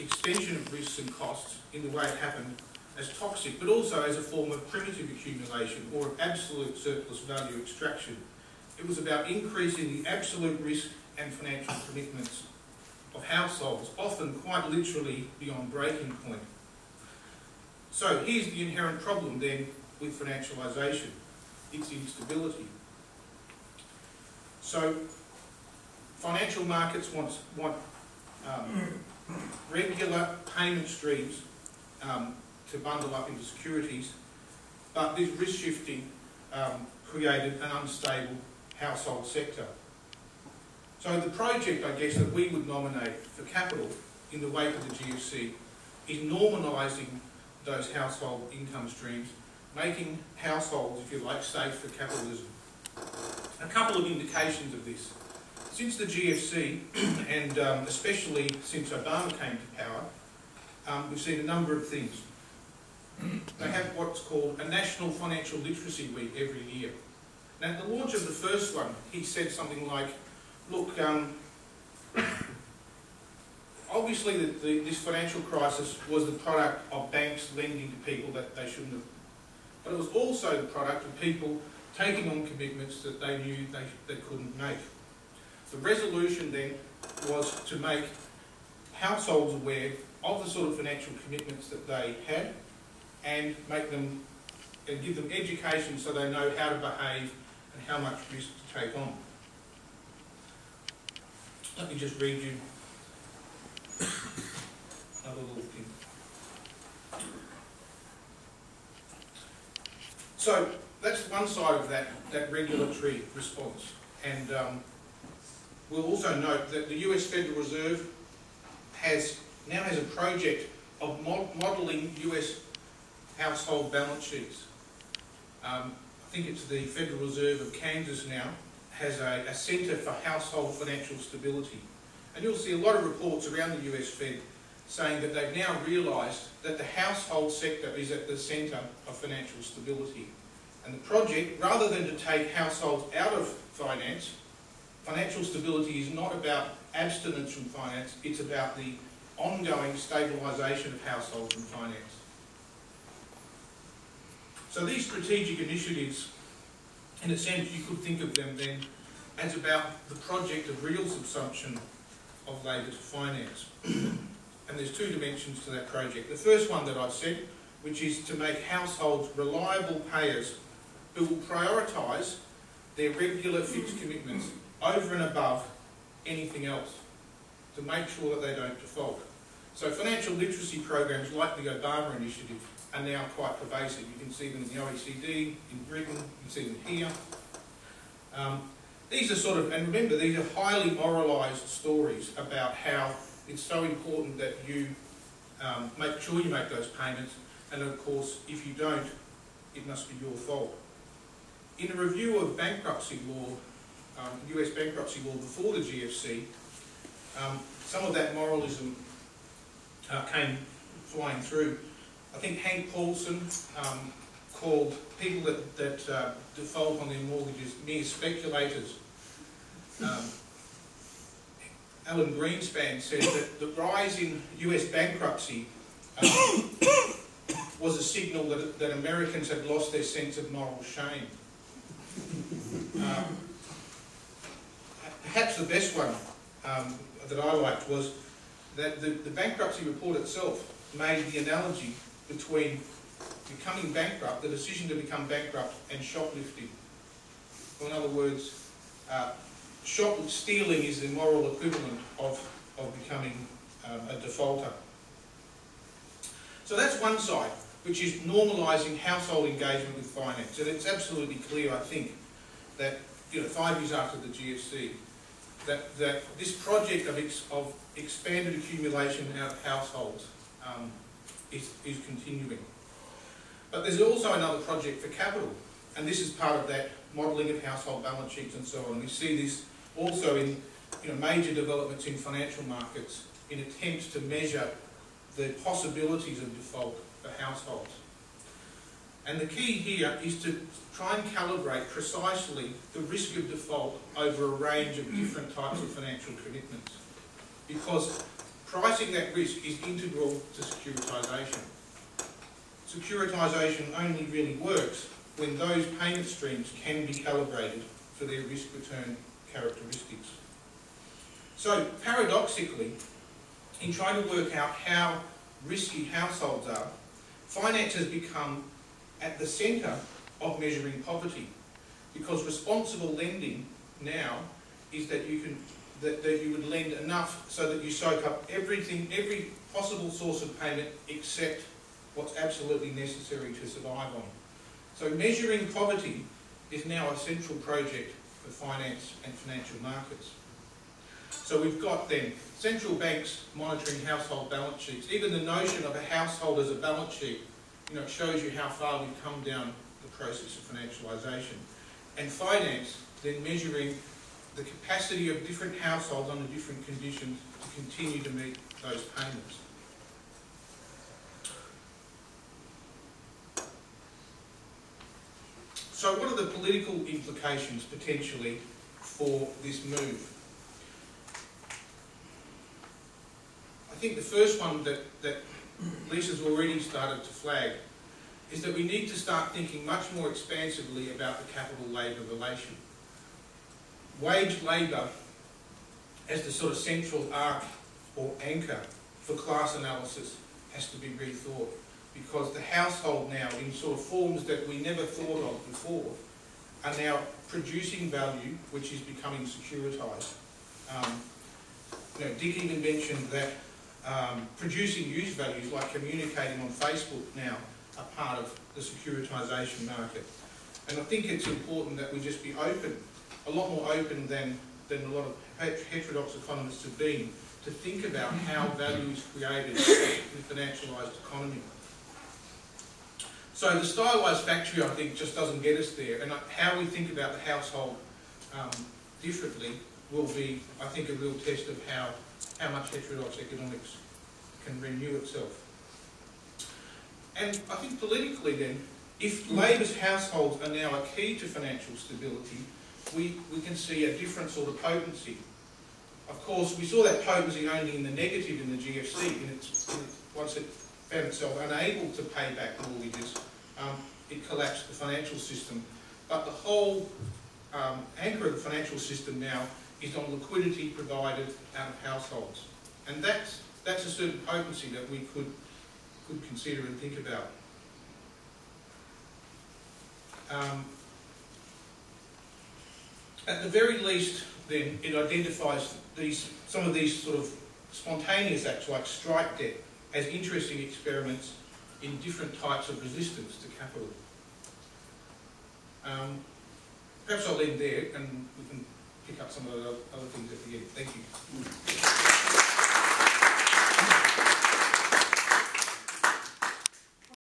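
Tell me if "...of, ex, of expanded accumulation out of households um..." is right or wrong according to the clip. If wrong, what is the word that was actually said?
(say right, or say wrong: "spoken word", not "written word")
right.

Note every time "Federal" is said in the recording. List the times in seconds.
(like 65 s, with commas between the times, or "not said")
117 s, 126 s.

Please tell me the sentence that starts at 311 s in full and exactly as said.
So paradoxically, in trying to work out how risky households are, finance has become at the centre of measuring poverty.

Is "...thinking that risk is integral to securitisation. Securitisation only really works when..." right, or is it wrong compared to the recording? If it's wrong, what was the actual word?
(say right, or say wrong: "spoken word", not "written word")
wrong: "pricing", not "thinking".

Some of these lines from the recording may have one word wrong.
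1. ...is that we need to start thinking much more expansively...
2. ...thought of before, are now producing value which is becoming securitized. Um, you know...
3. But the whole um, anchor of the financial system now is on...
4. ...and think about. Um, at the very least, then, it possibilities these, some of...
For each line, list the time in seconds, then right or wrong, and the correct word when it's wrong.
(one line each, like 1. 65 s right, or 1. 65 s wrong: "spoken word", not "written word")
1. 378 s right
2. 395 s right
3. 456 s right
4. 466 s wrong: "identifies", not "possibilities".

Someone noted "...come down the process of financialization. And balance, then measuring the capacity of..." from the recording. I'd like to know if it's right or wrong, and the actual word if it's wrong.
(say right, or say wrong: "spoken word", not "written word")
wrong: "finance", not "balance".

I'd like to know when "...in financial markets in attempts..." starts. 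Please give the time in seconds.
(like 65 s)
282 s.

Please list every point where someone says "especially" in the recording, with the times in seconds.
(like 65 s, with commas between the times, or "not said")
57 s.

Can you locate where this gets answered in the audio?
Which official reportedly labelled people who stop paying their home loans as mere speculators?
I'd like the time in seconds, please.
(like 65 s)
212 s.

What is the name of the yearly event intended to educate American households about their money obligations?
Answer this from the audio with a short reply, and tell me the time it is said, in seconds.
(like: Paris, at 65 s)
National Financial Literacy Week, at 64 s.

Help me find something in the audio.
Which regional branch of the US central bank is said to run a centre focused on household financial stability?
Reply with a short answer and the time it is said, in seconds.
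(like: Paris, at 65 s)
Kansas, at 127 s.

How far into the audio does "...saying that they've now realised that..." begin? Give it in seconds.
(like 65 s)
134 s.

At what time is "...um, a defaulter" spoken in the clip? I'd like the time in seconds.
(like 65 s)
253 s.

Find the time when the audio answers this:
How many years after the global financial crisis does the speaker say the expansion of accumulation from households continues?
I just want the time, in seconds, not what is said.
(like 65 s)
263 s.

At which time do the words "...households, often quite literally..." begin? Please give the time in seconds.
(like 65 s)
13 s.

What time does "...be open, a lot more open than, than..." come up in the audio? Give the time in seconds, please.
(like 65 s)
412 s.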